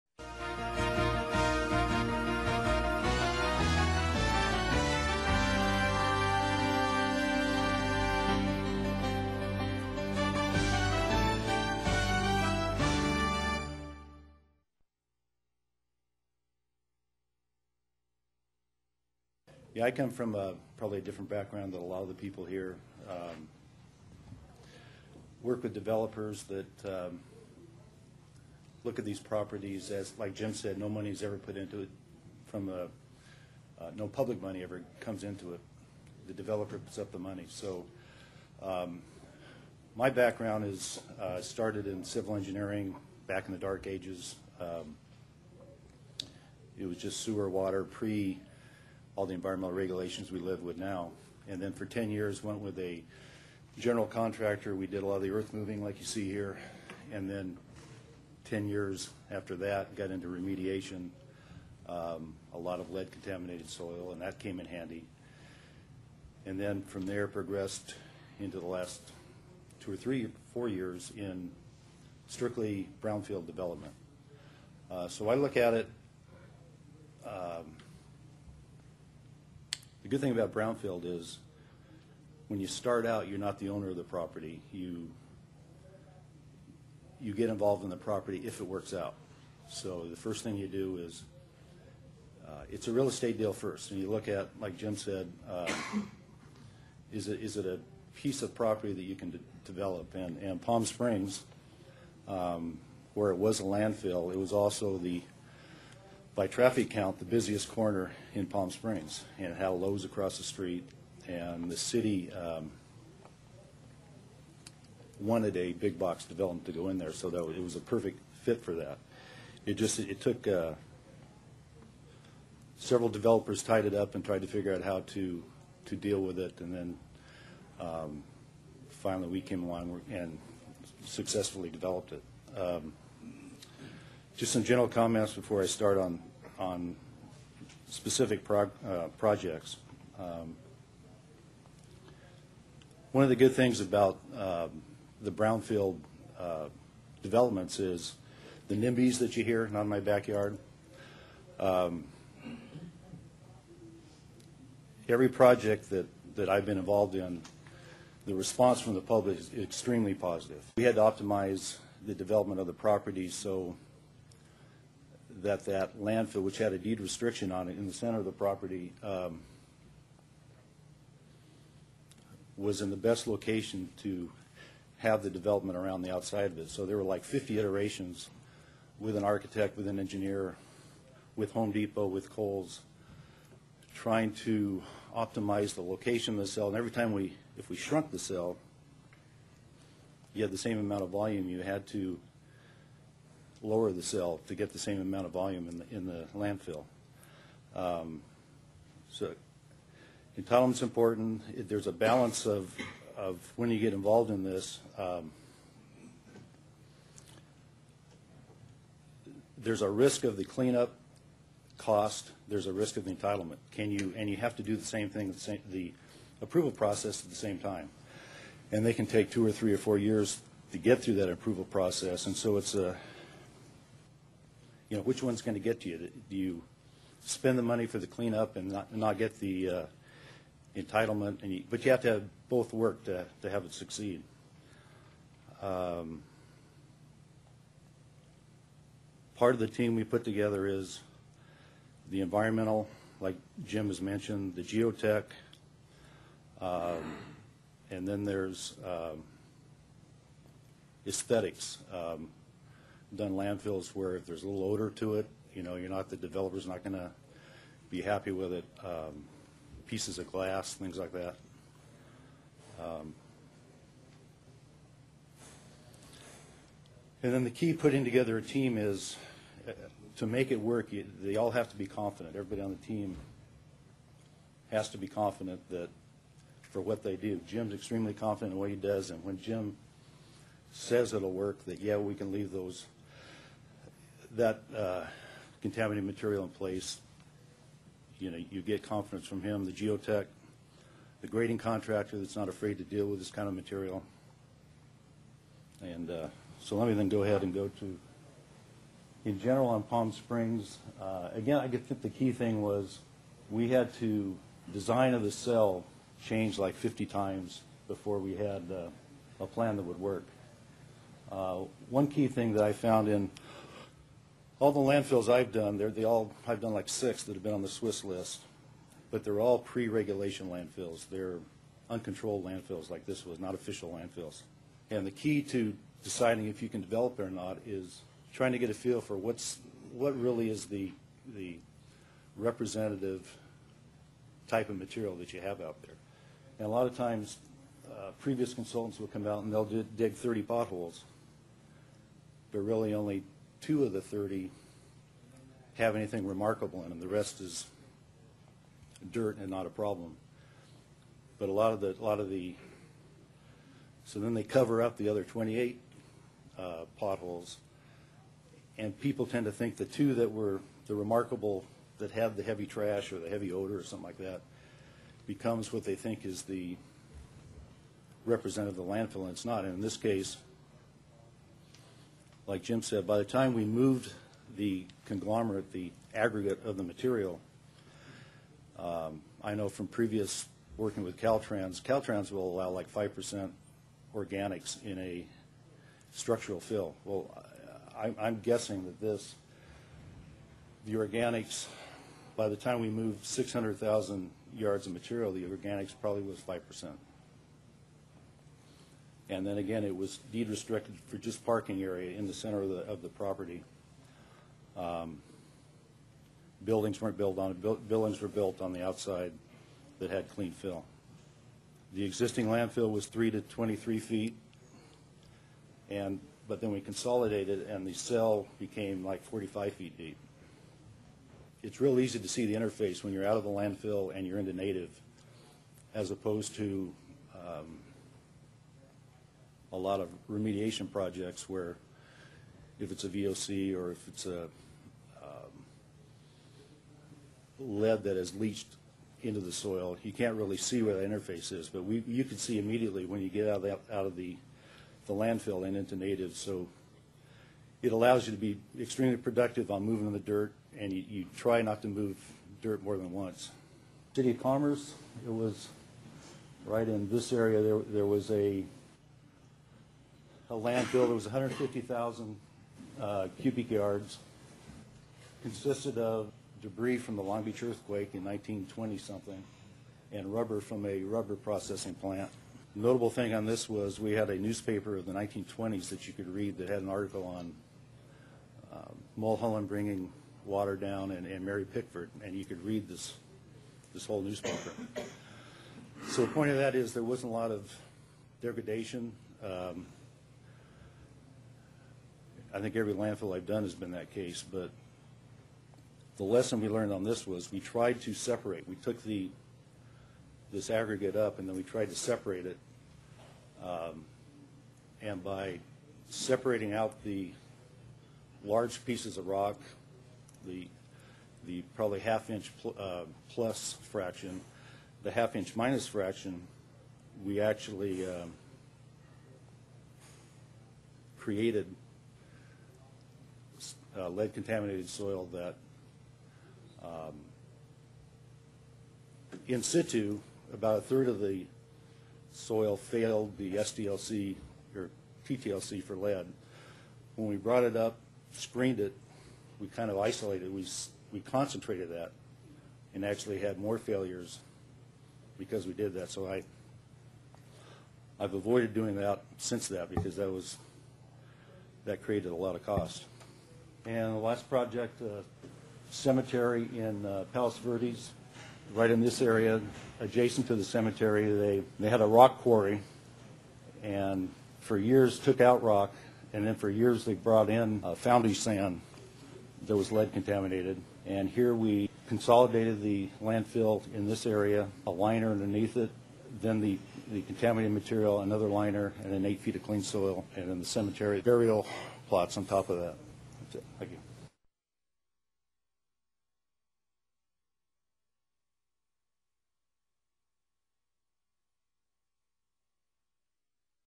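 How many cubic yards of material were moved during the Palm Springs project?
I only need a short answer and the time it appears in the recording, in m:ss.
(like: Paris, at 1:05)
600,000, at 6:33.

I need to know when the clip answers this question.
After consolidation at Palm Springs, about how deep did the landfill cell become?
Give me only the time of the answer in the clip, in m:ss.
6:59.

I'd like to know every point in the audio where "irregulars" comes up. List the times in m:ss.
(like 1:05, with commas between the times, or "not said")
not said.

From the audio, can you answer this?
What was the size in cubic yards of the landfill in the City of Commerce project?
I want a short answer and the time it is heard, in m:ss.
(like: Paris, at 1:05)
150,000, at 7:41.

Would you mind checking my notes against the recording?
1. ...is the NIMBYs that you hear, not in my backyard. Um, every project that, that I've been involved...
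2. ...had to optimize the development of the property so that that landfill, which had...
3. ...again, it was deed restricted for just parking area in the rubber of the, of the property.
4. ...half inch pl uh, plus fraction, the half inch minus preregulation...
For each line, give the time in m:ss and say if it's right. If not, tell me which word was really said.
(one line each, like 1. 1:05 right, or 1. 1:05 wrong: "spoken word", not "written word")
1. 2:27 right
2. 2:40 right
3. 6:39 wrong: "center", not "rubber"
4. 8:32 wrong: "fraction", not "preregulation".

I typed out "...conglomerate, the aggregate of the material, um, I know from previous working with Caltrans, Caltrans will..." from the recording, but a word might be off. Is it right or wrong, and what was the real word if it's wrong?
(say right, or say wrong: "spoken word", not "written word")
right.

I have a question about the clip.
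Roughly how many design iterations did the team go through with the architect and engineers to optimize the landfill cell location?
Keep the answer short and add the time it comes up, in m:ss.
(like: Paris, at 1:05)
50, at 2:57.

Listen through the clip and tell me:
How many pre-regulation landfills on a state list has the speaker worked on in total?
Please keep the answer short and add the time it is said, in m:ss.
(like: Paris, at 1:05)
6, at 5:16.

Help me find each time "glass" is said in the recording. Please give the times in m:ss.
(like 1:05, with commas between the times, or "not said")
4:20.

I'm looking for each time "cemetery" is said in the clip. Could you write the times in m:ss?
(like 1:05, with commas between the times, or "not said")
9:15, 9:20, 9:40.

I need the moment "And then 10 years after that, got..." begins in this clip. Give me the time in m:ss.
0:57.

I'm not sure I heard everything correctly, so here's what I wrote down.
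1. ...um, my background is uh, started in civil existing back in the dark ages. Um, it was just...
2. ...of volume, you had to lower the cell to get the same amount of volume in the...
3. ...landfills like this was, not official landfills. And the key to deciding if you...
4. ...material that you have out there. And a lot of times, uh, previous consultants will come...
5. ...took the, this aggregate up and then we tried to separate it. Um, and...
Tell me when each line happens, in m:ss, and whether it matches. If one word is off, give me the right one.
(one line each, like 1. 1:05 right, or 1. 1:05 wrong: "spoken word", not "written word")
1. 0:38 wrong: "engineering", not "existing"
2. 3:11 right
3. 5:22 right
4. 5:34 right
5. 8:18 right.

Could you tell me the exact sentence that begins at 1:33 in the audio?
And you look at, like Jim said, uh, is, it, is it a piece of property that you can de develop?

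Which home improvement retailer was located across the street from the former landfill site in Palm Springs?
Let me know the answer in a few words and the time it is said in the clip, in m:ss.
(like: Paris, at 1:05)
Lowe's, at 1:49.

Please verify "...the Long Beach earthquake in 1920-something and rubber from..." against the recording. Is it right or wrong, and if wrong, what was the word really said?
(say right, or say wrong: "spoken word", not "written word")
right.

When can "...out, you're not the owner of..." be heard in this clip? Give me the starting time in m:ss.
1:23.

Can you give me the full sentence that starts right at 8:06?
So the point of that is there wasn't a lot of degradation.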